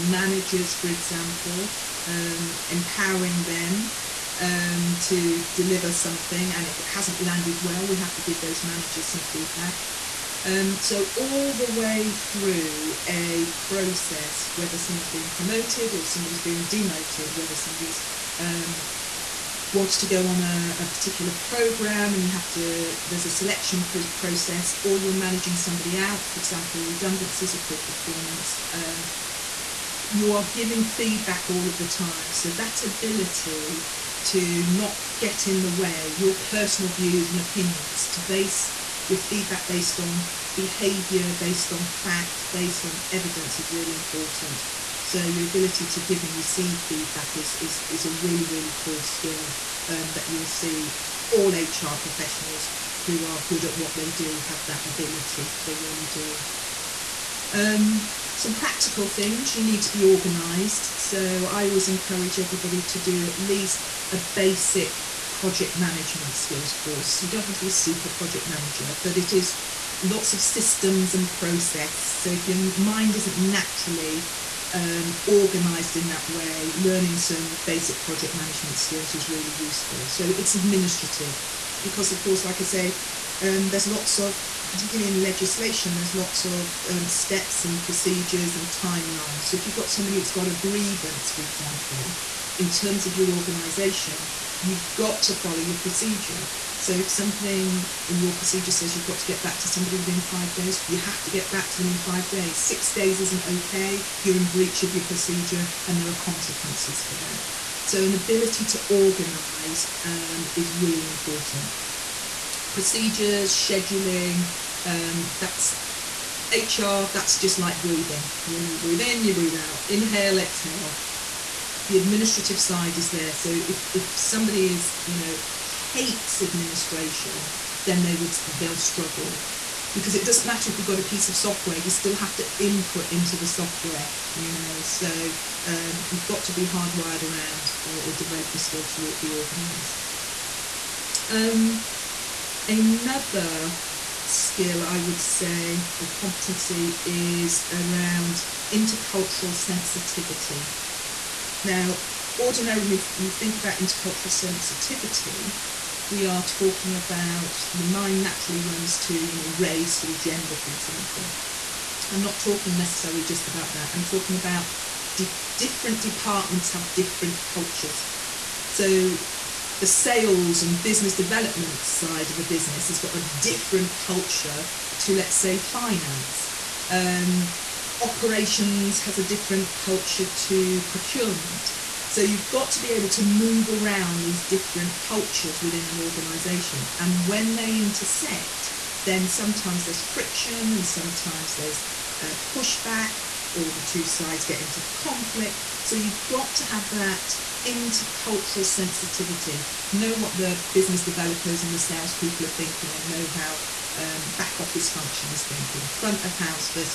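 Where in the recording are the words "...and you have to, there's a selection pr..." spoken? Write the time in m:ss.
0:22.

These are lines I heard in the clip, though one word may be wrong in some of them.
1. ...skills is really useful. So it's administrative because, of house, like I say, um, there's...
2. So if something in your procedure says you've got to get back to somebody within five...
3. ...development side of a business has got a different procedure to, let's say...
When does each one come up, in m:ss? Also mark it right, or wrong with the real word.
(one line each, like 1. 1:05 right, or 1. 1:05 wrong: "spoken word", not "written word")
1. 1:18 wrong: "course", not "house"
2. 1:36 right
3. 2:51 wrong: "culture", not "procedure".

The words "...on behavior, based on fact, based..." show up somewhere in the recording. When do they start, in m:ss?
0:39.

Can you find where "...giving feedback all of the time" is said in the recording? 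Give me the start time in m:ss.
0:30.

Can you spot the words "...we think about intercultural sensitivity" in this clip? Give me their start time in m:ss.
2:33.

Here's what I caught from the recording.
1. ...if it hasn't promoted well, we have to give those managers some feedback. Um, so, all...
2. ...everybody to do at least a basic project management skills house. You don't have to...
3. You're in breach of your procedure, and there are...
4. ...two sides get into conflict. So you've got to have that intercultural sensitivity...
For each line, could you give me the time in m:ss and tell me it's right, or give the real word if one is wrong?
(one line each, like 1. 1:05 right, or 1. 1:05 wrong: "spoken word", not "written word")
1. 0:06 wrong: "landed", not "promoted"
2. 1:02 wrong: "course", not "house"
3. 1:44 right
4. 3:13 right.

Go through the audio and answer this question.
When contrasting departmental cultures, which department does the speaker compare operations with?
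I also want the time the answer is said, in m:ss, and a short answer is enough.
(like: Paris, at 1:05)
procurement, at 3:00.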